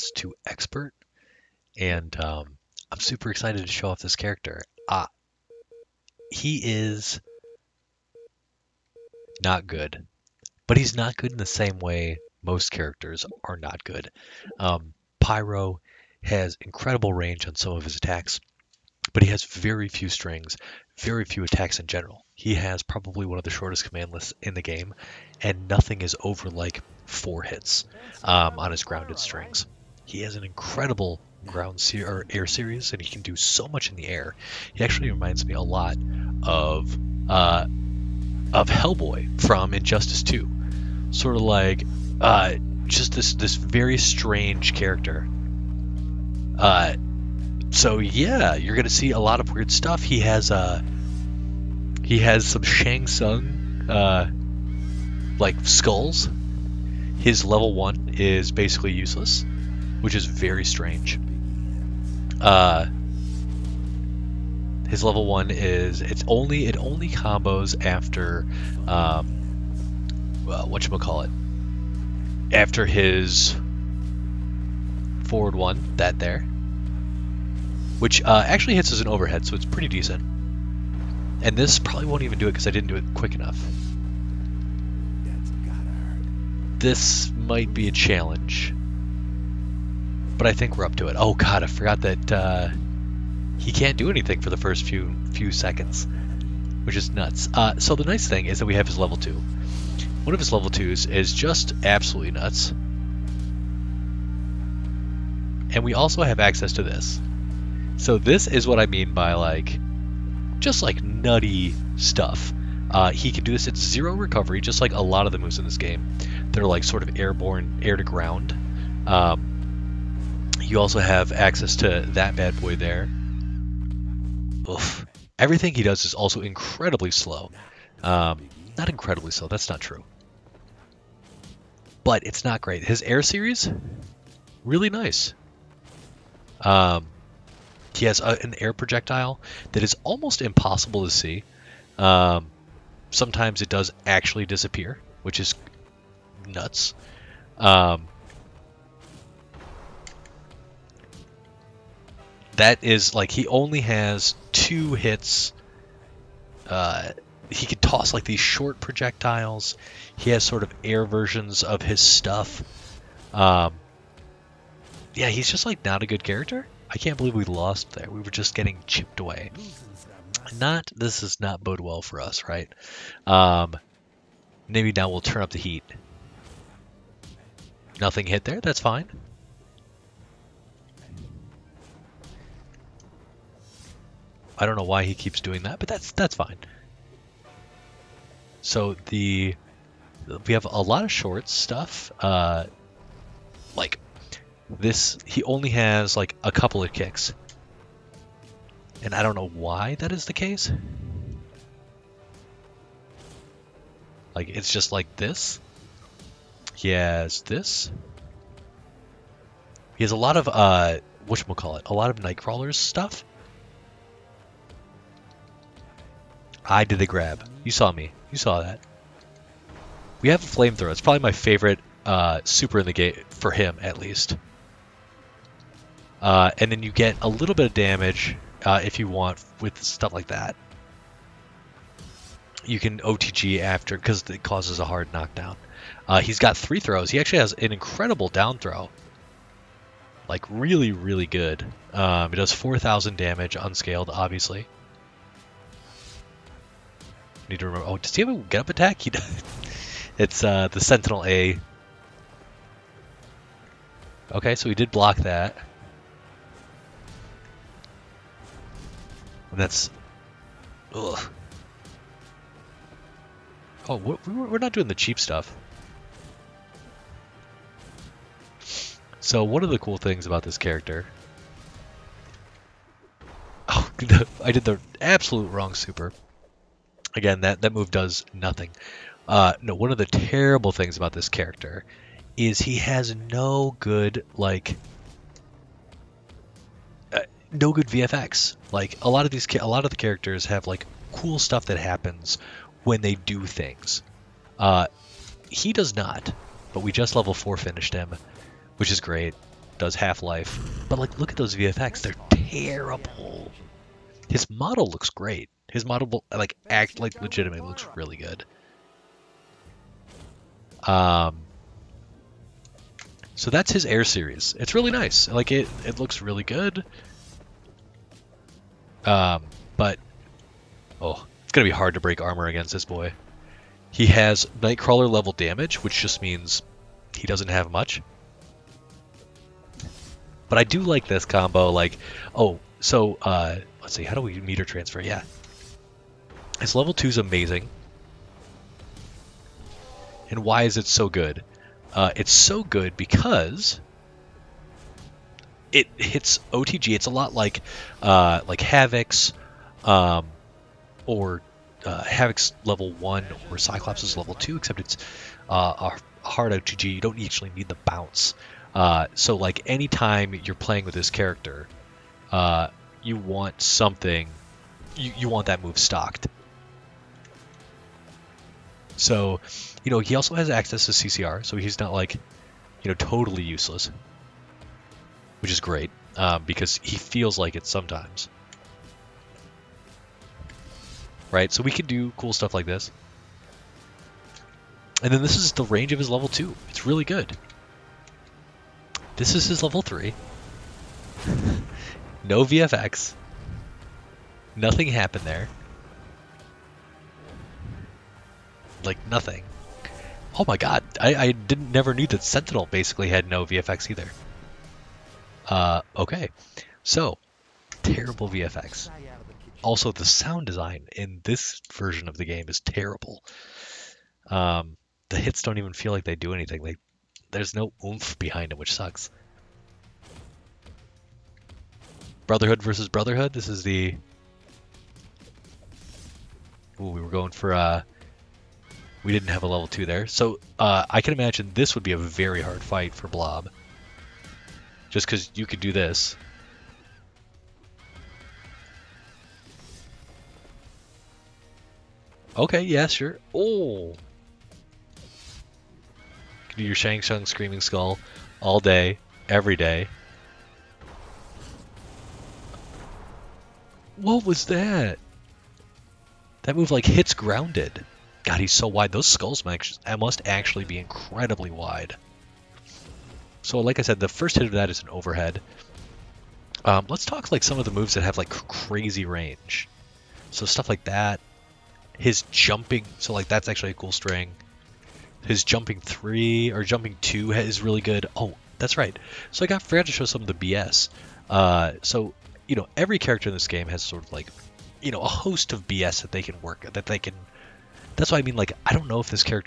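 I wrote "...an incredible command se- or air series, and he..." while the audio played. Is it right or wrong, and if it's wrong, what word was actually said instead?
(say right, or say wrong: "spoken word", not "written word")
wrong: "ground", not "command".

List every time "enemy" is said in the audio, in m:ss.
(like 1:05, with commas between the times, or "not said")
not said.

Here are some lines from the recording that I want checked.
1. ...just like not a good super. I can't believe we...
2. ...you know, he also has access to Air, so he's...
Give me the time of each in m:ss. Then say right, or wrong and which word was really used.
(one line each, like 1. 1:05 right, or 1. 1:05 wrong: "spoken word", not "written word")
1. 2:45 wrong: "character", not "super"
2. 6:09 wrong: "CCR", not "Air".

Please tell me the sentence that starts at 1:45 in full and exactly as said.
And we also have access to this.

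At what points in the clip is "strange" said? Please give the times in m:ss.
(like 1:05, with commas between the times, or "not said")
0:43, 1:00.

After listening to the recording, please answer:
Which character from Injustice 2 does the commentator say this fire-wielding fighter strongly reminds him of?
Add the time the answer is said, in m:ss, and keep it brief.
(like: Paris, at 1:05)
Hellboy, at 0:38.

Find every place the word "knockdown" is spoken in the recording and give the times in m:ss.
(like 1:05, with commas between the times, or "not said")
3:55.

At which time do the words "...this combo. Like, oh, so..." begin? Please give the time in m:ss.
5:31.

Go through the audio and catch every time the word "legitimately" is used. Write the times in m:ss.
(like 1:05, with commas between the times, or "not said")
5:07.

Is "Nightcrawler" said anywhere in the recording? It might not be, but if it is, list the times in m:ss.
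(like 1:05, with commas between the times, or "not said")
3:32, 5:24.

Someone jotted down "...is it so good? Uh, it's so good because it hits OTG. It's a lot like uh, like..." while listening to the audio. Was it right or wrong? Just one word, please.
right.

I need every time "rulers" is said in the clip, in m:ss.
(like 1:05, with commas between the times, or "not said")
not said.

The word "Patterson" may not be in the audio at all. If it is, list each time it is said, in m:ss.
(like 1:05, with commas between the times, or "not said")
not said.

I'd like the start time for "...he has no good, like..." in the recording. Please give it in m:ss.
4:42.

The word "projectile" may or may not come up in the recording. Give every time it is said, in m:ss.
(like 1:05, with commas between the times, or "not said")
2:18, 2:38.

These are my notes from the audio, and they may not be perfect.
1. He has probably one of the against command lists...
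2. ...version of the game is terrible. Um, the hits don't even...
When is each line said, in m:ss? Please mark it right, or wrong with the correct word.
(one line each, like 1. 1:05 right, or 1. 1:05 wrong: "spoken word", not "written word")
1. 0:22 wrong: "shortest", not "against"
2. 6:51 right.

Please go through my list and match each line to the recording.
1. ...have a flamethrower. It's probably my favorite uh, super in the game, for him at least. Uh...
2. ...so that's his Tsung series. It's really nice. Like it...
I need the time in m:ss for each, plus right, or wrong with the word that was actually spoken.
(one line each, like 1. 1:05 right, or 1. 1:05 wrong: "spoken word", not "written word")
1. 3:40 right
2. 5:13 wrong: "Air", not "Tsung".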